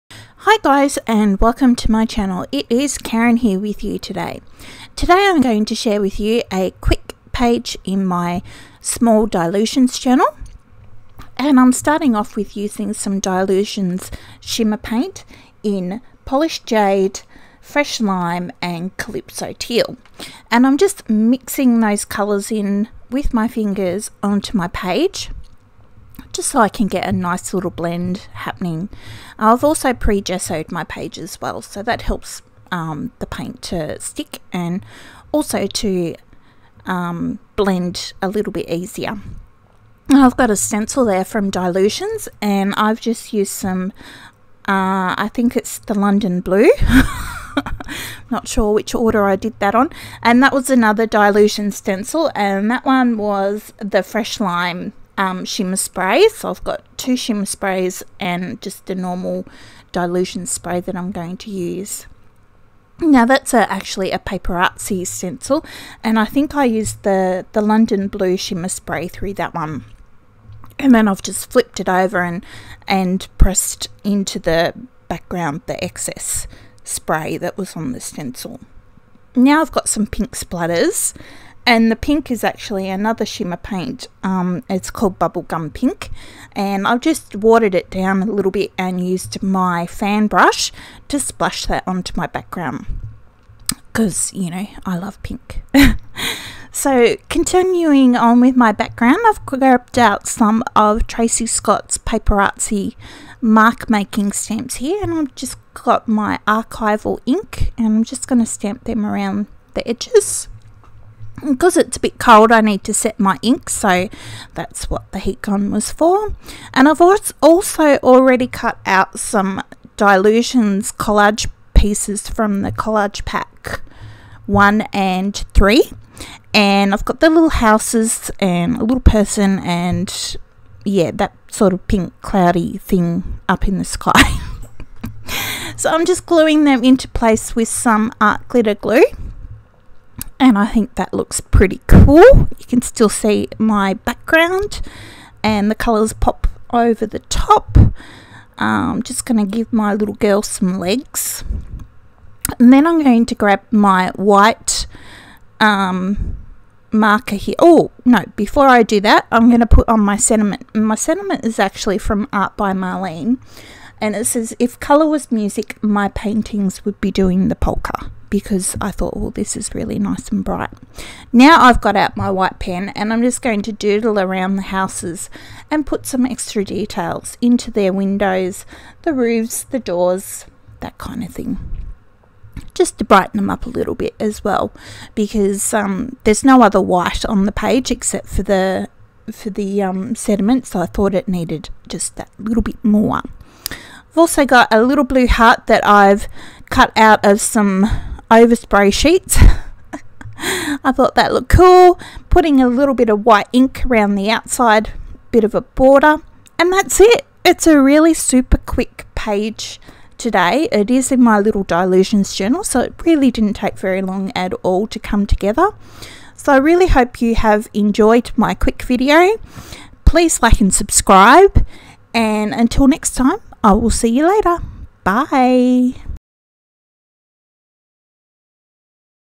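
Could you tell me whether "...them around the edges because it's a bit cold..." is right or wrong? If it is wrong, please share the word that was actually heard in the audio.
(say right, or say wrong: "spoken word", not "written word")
right.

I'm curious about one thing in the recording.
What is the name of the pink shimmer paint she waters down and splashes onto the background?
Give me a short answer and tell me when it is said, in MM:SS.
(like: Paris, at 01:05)
Bubblegum Pink, at 01:25.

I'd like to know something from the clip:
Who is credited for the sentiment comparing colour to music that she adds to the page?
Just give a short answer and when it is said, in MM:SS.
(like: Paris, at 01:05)
Art by Marlene, at 02:42.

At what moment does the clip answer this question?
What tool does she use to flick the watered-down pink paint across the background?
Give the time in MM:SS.
01:29.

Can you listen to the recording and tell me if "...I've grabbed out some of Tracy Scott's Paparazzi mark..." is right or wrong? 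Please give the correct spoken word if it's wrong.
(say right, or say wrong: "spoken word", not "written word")
right.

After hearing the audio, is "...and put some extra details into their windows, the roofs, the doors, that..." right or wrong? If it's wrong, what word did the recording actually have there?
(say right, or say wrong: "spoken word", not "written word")
right.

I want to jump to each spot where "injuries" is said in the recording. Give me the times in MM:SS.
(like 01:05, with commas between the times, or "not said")
not said.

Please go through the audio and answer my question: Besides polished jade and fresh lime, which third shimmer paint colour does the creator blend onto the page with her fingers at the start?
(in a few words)
Calypso Teal.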